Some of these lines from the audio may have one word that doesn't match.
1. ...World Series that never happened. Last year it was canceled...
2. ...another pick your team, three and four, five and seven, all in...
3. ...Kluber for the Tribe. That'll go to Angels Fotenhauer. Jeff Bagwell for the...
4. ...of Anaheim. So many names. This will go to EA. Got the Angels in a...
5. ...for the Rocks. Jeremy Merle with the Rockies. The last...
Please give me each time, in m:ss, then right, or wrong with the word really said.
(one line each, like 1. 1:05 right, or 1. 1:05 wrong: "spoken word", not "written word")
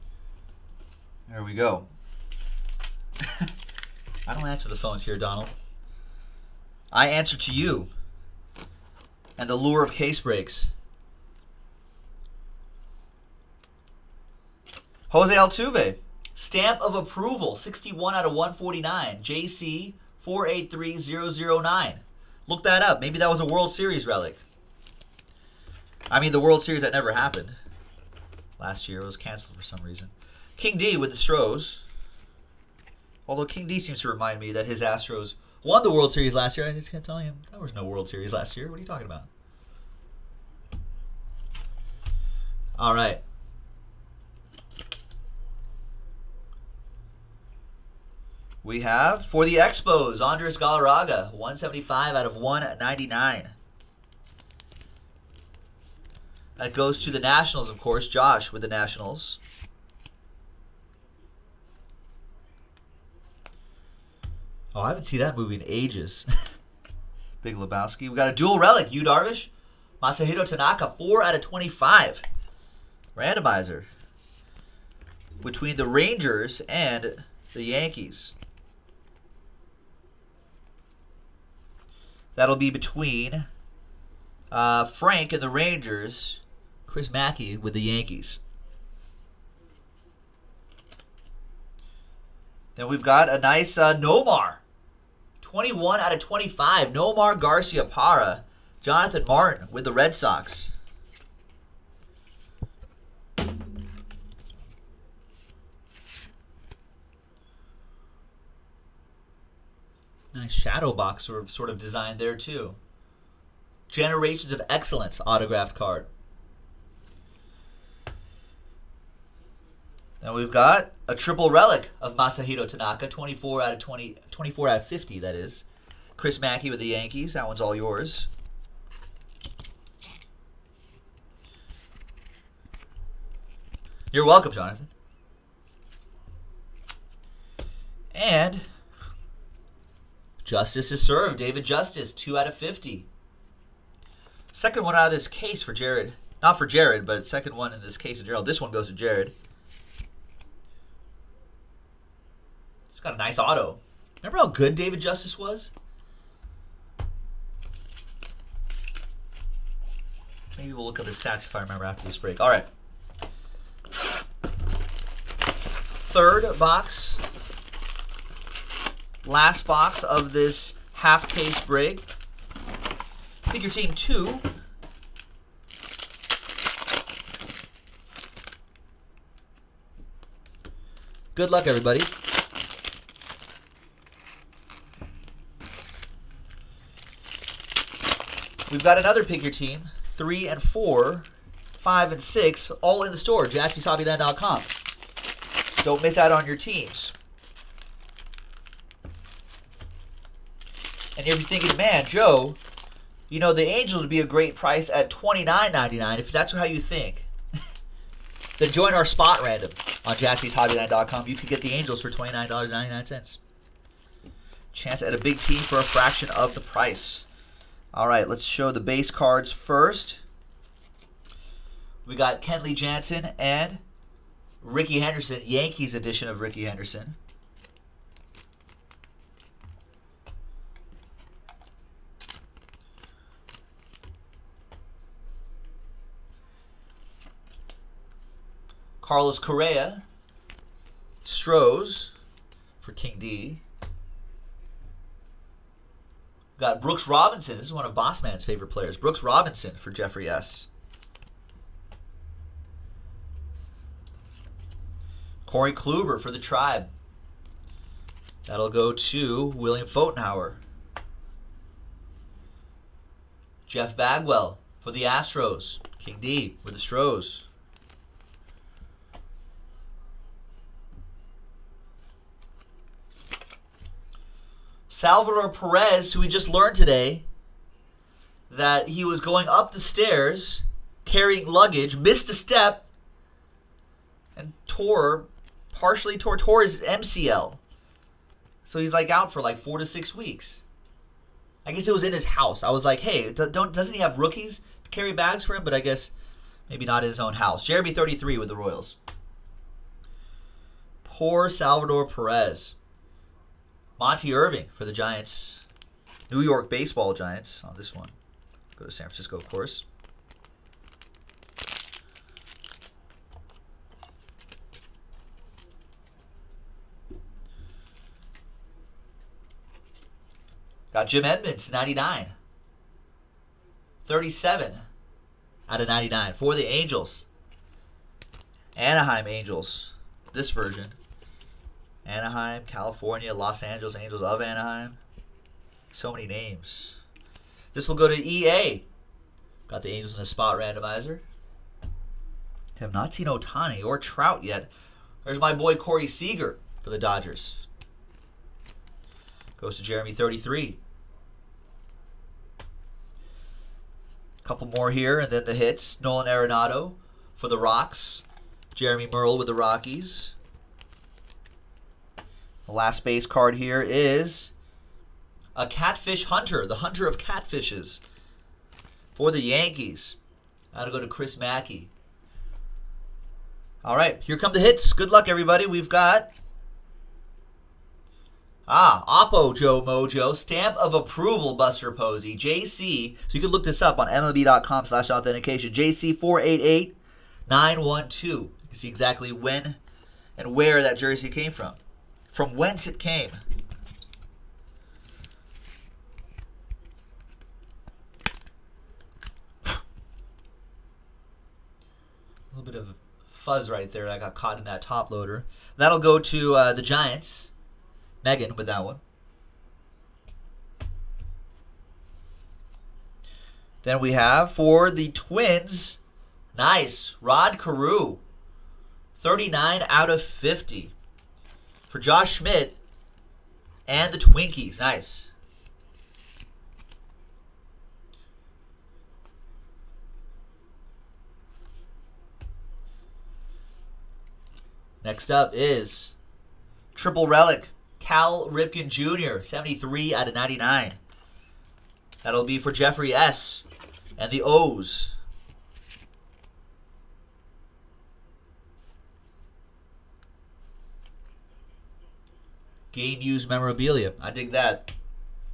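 1. 0:26 right
2. 3:08 wrong: "six", not "seven"
3. 4:15 wrong: "William", not "Angels"
4. 5:34 right
5. 5:57 right.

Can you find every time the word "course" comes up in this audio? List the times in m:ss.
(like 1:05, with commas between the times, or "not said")
0:57, 5:09.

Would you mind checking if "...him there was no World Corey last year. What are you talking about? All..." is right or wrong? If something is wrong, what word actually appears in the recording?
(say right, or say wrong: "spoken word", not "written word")
wrong: "Series", not "Corey".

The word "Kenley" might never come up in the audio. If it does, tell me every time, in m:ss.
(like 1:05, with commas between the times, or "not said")
3:42.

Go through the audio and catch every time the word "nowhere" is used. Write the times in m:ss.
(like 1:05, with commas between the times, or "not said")
not said.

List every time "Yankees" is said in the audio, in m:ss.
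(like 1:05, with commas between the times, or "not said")
1:17, 1:27, 2:06, 3:45, 6:09.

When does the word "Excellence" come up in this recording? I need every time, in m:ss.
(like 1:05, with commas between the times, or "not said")
1:54.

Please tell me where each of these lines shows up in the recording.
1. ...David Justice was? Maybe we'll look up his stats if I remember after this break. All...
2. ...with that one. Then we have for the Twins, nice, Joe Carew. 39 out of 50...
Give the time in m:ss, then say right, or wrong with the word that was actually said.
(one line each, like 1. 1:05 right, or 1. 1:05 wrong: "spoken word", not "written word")
1. 2:34 right
2. 6:48 wrong: "Rod", not "Joe".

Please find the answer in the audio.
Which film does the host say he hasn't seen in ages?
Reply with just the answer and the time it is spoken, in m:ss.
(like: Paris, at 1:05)
Big Lebowski, at 1:07.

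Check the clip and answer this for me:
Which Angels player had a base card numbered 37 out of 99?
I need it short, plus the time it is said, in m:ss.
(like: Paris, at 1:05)
Jim Edmonds, at 5:21.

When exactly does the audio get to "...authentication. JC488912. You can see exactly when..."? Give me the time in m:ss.
6:25.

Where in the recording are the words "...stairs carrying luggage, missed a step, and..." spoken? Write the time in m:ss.
4:39.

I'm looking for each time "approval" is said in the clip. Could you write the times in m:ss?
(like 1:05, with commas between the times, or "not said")
0:16, 6:20.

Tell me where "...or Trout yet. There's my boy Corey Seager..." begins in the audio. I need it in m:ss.
5:43.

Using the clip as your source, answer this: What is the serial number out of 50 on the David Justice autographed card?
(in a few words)
2 out of 50.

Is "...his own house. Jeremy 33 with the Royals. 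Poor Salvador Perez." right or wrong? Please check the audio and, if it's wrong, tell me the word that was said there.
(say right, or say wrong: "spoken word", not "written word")
right.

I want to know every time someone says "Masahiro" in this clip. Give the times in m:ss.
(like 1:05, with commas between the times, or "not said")
1:10, 2:02.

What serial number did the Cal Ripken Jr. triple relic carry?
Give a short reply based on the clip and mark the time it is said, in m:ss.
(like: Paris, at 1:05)
73 out of 99, at 7:19.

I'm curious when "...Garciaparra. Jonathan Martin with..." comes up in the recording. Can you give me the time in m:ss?
1:37.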